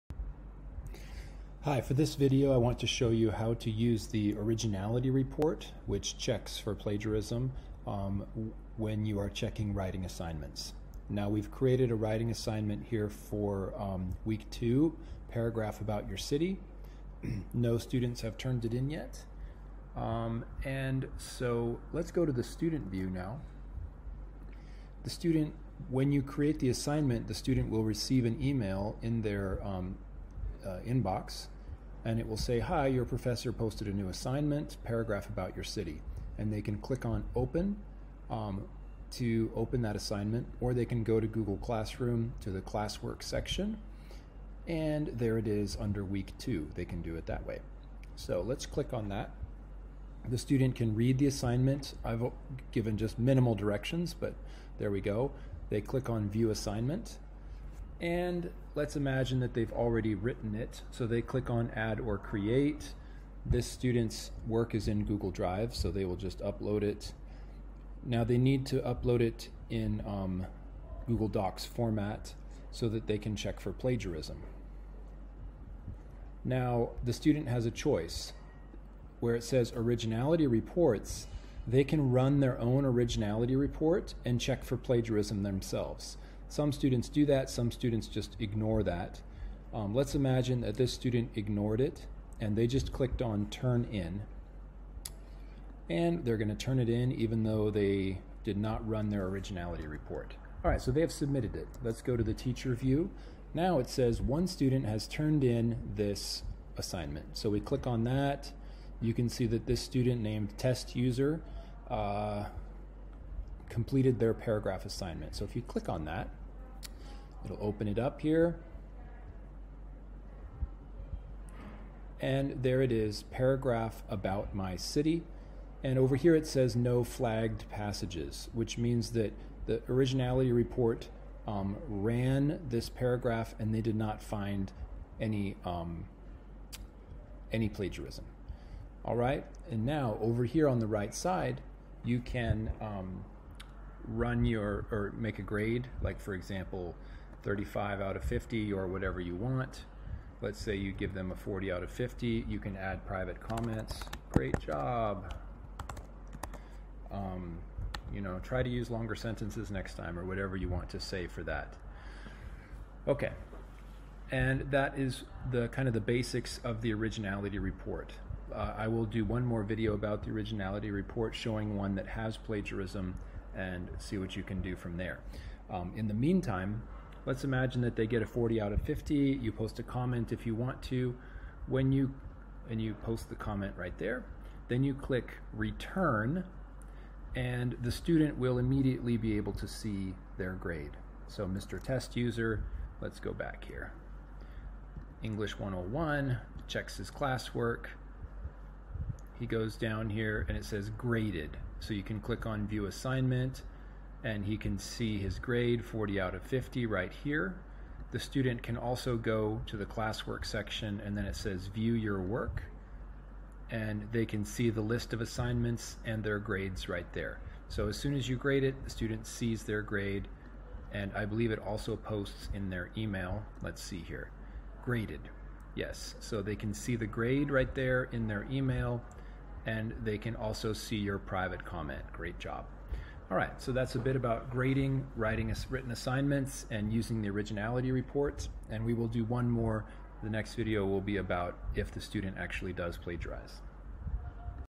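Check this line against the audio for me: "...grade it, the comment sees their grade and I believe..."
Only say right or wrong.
wrong.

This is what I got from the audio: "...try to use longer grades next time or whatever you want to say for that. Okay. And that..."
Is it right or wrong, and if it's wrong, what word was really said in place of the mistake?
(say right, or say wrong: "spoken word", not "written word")
wrong: "sentences", not "grades".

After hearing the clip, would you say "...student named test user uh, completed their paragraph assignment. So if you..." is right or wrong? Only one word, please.
right.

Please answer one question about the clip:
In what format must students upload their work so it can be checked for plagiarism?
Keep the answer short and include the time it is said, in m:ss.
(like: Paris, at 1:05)
Google Docs, at 1:11.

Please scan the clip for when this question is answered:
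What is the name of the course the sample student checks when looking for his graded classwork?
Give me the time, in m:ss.
3:15.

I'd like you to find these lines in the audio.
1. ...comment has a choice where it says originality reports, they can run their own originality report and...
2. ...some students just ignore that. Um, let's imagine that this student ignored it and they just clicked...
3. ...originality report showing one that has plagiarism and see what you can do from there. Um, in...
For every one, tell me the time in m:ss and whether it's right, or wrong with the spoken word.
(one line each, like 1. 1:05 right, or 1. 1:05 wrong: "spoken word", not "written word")
1. 1:17 wrong: "student", not "comment"
2. 1:27 right
3. 2:50 right.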